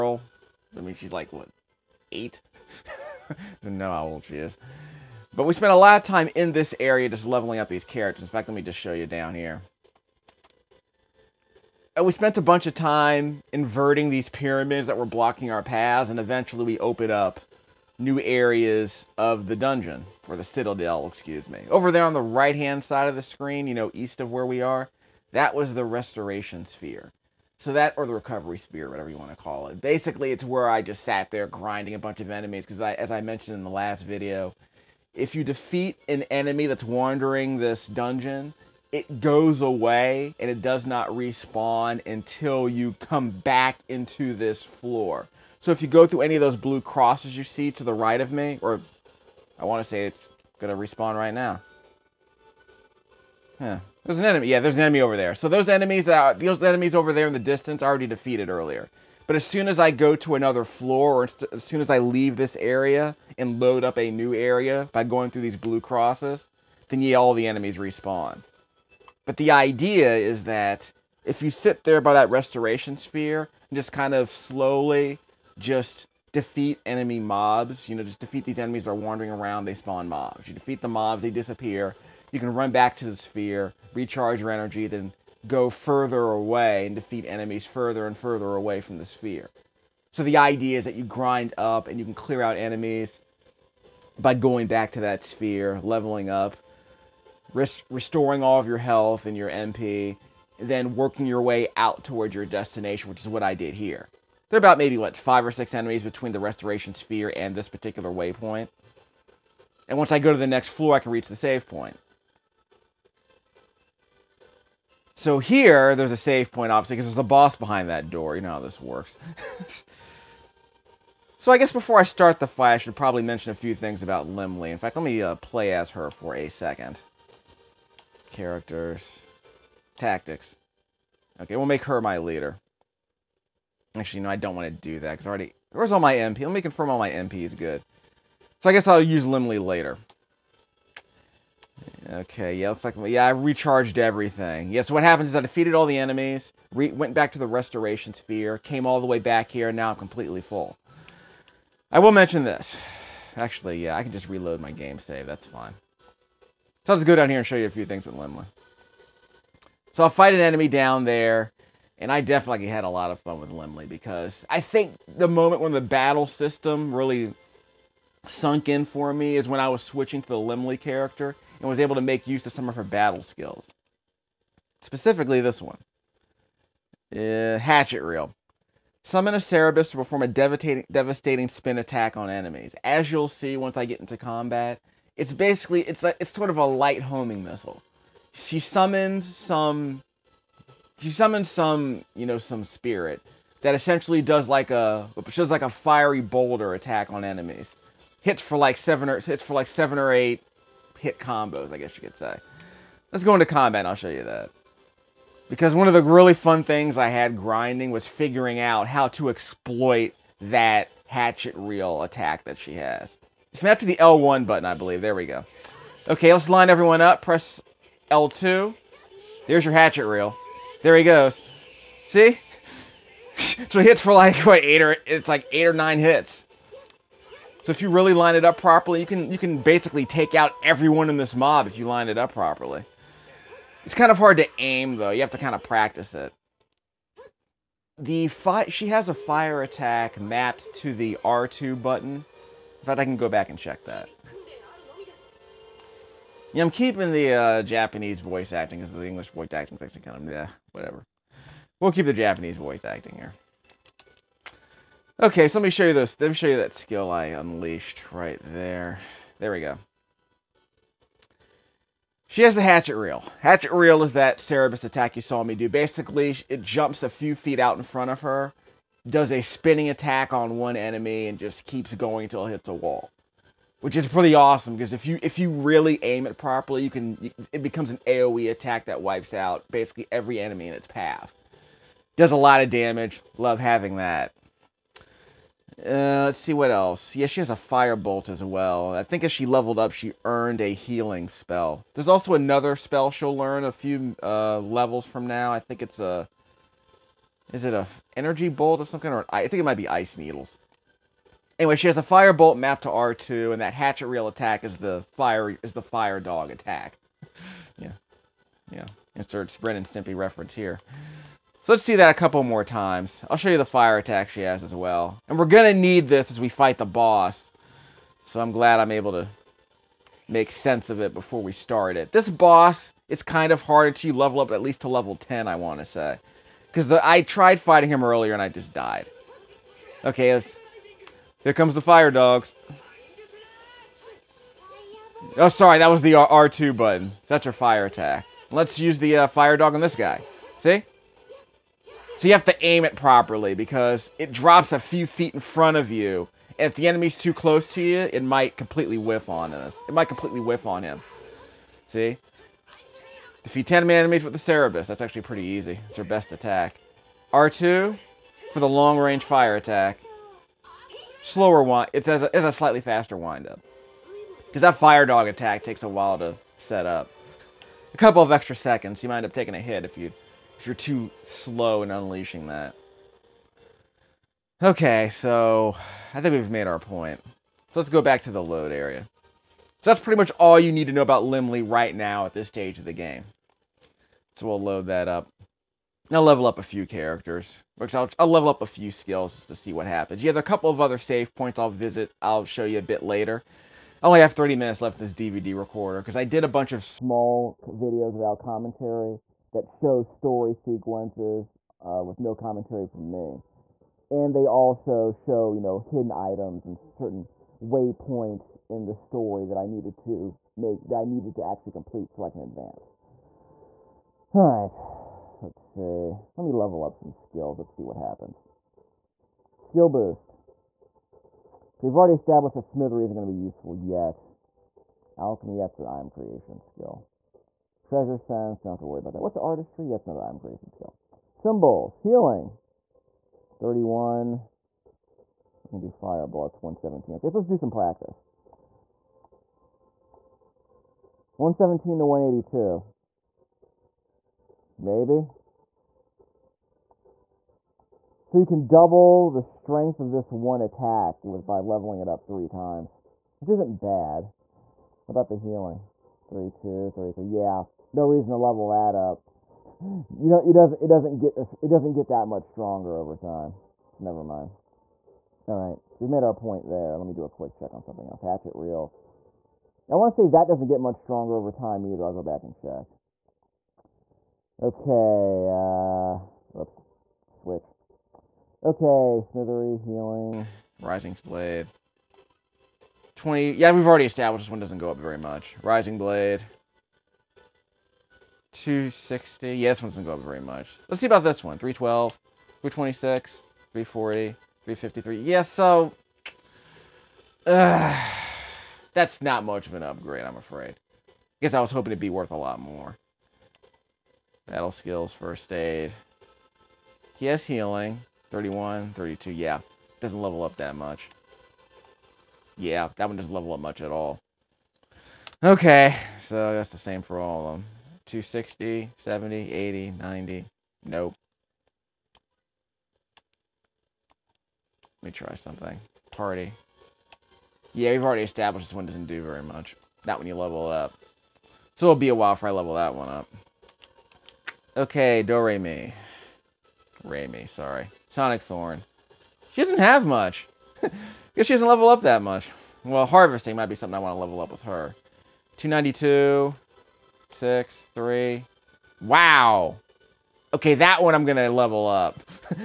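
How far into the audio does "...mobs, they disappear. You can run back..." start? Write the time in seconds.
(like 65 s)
80 s.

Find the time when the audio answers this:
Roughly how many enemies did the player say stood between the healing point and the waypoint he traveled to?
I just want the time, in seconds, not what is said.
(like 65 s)
105 s.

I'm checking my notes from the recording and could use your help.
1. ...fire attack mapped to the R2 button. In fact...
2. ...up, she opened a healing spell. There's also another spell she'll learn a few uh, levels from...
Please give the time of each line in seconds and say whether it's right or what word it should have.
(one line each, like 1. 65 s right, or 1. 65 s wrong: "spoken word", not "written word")
1. 239 s right
2. 289 s wrong: "earned", not "opened".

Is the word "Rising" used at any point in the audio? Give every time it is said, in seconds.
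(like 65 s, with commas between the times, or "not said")
480 s, 485 s.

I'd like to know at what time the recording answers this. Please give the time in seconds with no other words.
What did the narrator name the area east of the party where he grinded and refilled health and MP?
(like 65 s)
28 s.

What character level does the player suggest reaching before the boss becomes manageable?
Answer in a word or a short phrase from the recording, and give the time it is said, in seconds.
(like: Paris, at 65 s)
Level 10, at 324 s.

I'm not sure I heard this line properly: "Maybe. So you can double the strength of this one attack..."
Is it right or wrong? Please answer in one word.
right.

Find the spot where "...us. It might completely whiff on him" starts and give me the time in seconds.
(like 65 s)
349 s.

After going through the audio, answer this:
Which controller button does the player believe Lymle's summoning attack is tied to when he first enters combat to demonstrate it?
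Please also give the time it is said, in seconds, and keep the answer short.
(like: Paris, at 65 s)
L1, at 213 s.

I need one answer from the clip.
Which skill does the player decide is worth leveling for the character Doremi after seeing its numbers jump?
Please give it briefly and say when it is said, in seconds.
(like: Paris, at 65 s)
Harvesting, at 543 s.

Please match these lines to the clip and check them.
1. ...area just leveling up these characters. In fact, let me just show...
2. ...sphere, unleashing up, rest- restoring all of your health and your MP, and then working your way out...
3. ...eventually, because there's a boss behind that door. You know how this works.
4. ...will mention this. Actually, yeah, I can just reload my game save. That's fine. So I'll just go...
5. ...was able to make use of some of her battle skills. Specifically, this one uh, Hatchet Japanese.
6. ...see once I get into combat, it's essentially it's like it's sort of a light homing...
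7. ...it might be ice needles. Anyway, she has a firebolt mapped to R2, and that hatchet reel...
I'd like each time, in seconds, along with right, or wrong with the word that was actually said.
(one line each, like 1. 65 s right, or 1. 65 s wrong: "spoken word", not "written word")
1. 6 s right
2. 95 s wrong: "leveling", not "unleashing"
3. 116 s wrong: "obviously", not "eventually"
4. 151 s right
5. 171 s wrong: "Reel", not "Japanese"
6. 183 s wrong: "basically", not "essentially"
7. 299 s right.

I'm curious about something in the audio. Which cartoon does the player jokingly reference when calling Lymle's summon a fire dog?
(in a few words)
Ren and Stimpy.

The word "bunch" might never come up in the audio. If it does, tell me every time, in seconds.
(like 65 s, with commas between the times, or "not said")
12 s, 31 s, 396 s.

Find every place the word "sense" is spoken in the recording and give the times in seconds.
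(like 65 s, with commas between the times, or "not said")
320 s, 428 s.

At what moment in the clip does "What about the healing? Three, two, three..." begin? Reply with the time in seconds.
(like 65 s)
455 s.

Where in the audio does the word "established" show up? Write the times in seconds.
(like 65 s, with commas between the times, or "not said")
422 s, 484 s, 528 s.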